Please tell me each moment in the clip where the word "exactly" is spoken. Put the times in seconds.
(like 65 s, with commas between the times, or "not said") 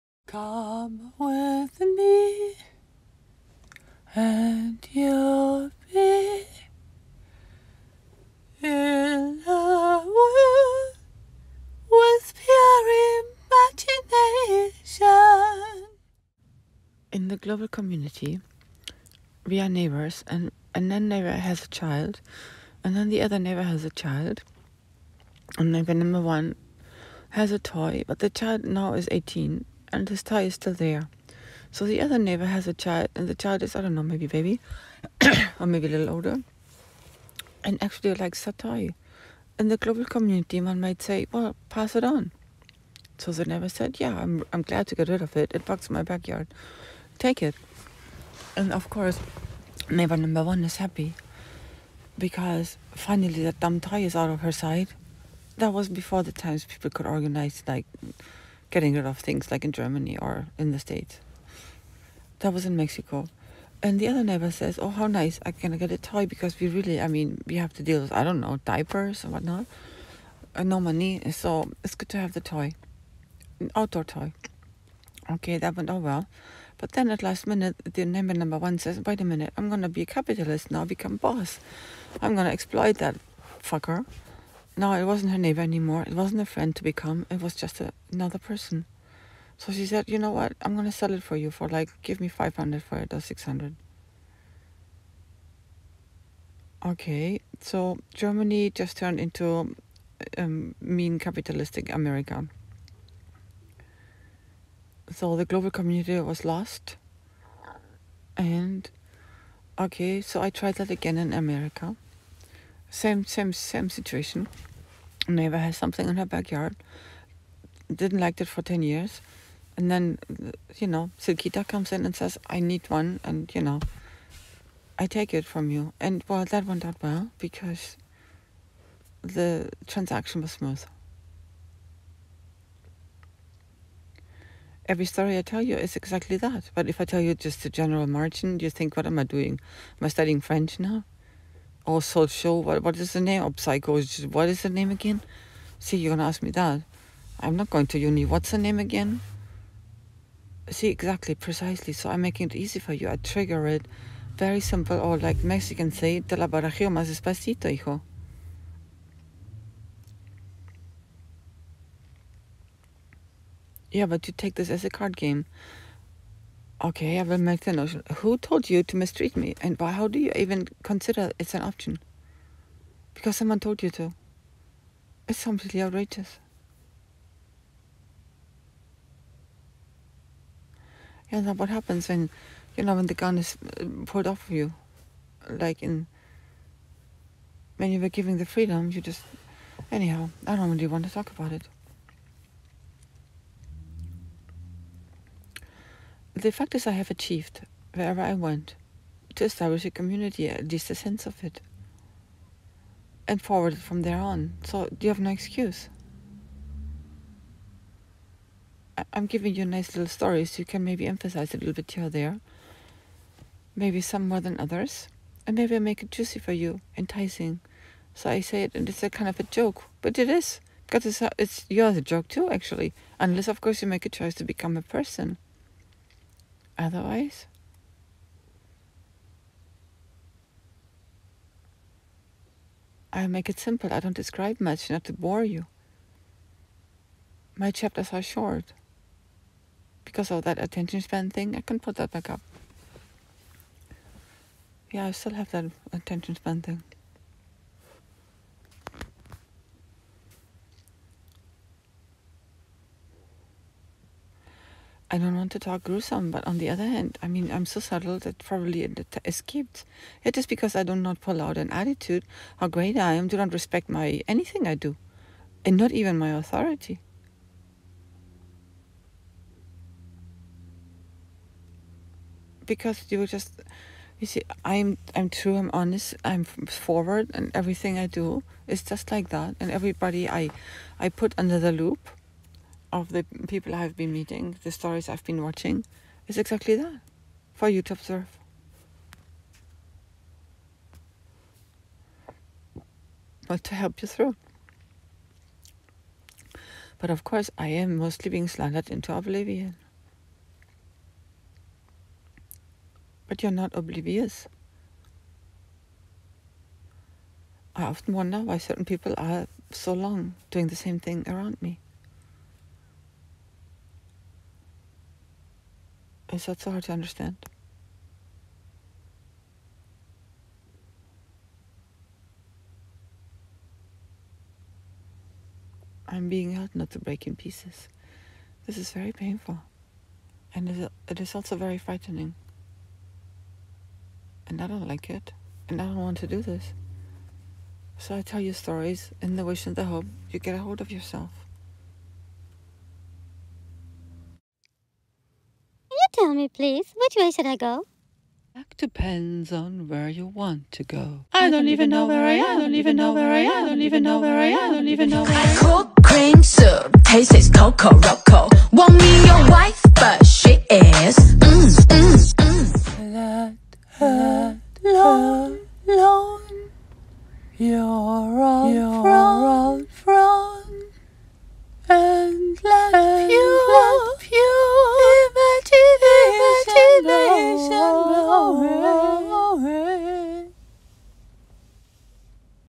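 135 s, 150 s, 286 s.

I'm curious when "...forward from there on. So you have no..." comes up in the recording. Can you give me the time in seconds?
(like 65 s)
203 s.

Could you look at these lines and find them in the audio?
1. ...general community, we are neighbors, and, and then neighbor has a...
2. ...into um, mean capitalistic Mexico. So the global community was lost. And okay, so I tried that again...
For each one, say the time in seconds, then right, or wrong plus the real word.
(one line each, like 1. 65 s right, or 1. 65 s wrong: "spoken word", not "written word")
1. 17 s wrong: "global", not "general"
2. 99 s wrong: "America", not "Mexico".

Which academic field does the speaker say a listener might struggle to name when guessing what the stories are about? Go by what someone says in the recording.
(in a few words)
psychology.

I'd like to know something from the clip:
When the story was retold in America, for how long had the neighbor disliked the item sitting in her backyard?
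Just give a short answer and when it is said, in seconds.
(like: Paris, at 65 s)
ten years, at 117 s.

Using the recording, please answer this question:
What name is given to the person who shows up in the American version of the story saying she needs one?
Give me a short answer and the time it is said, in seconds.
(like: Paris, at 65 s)
Silkita, at 120 s.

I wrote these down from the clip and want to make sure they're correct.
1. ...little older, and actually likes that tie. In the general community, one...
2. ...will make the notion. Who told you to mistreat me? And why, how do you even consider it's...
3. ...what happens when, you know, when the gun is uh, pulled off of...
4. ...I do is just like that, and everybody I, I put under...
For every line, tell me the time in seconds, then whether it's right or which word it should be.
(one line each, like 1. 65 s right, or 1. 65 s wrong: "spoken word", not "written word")
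1. 35 s wrong: "global", not "general"
2. 167 s right
3. 181 s right
4. 277 s right.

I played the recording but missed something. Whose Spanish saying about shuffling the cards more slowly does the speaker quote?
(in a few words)
Mexicans.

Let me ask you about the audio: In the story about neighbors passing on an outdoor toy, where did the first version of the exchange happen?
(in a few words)
Mexico.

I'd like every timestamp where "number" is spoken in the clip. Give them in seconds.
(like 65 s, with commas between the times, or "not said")
25 s, 50 s, 78 s.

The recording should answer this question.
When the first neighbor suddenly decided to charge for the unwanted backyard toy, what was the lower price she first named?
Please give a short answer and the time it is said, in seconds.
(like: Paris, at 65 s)
500, at 92 s.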